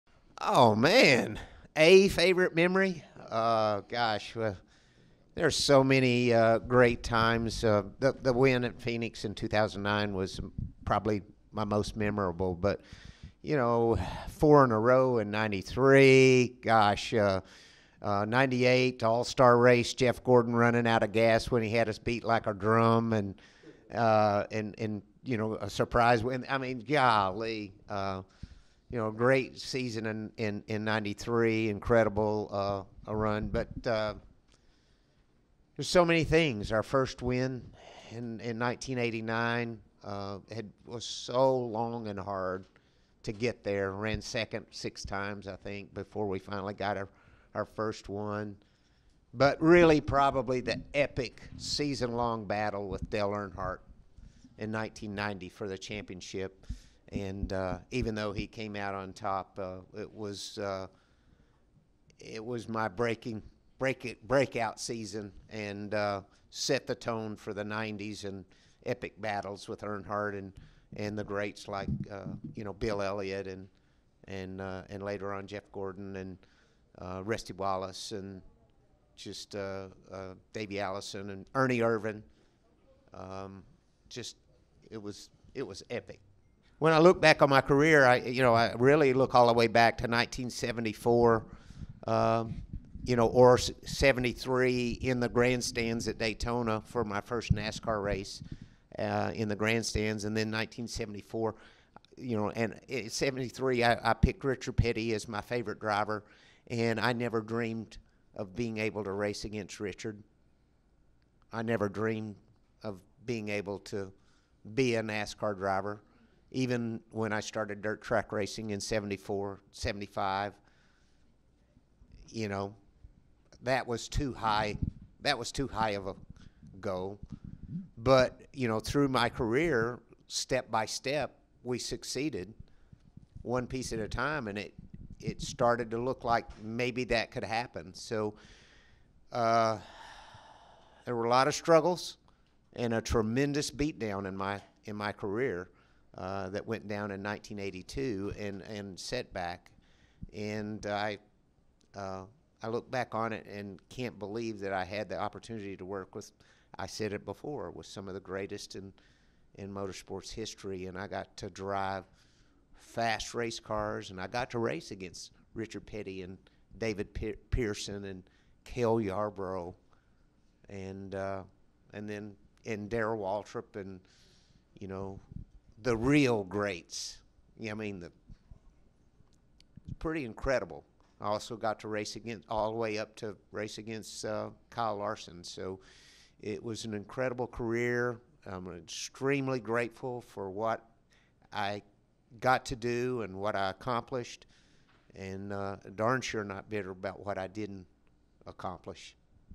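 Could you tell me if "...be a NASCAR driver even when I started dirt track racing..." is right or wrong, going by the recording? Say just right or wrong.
right.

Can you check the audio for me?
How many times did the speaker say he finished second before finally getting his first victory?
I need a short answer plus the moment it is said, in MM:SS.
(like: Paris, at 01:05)
6, at 00:44.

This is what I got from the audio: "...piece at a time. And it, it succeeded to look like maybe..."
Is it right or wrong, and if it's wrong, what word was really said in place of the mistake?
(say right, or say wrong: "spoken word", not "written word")
wrong: "started", not "succeeded".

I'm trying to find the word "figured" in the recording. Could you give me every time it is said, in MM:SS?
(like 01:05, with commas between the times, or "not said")
not said.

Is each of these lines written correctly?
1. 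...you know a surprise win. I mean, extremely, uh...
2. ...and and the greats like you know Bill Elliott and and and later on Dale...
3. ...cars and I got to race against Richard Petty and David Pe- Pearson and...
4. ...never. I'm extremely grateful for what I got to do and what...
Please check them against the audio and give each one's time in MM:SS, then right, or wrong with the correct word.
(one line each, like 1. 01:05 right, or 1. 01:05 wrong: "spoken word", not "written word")
1. 00:25 wrong: "golly", not "extremely"
2. 01:10 wrong: "Jeff", not "Dale"
3. 02:43 right
4. 03:07 wrong: "career", not "never".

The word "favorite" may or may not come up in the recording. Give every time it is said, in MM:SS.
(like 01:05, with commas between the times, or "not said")
00:02, 01:45.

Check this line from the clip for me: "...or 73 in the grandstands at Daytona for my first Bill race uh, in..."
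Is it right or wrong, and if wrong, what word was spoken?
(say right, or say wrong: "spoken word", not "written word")
wrong: "NASCAR", not "Bill".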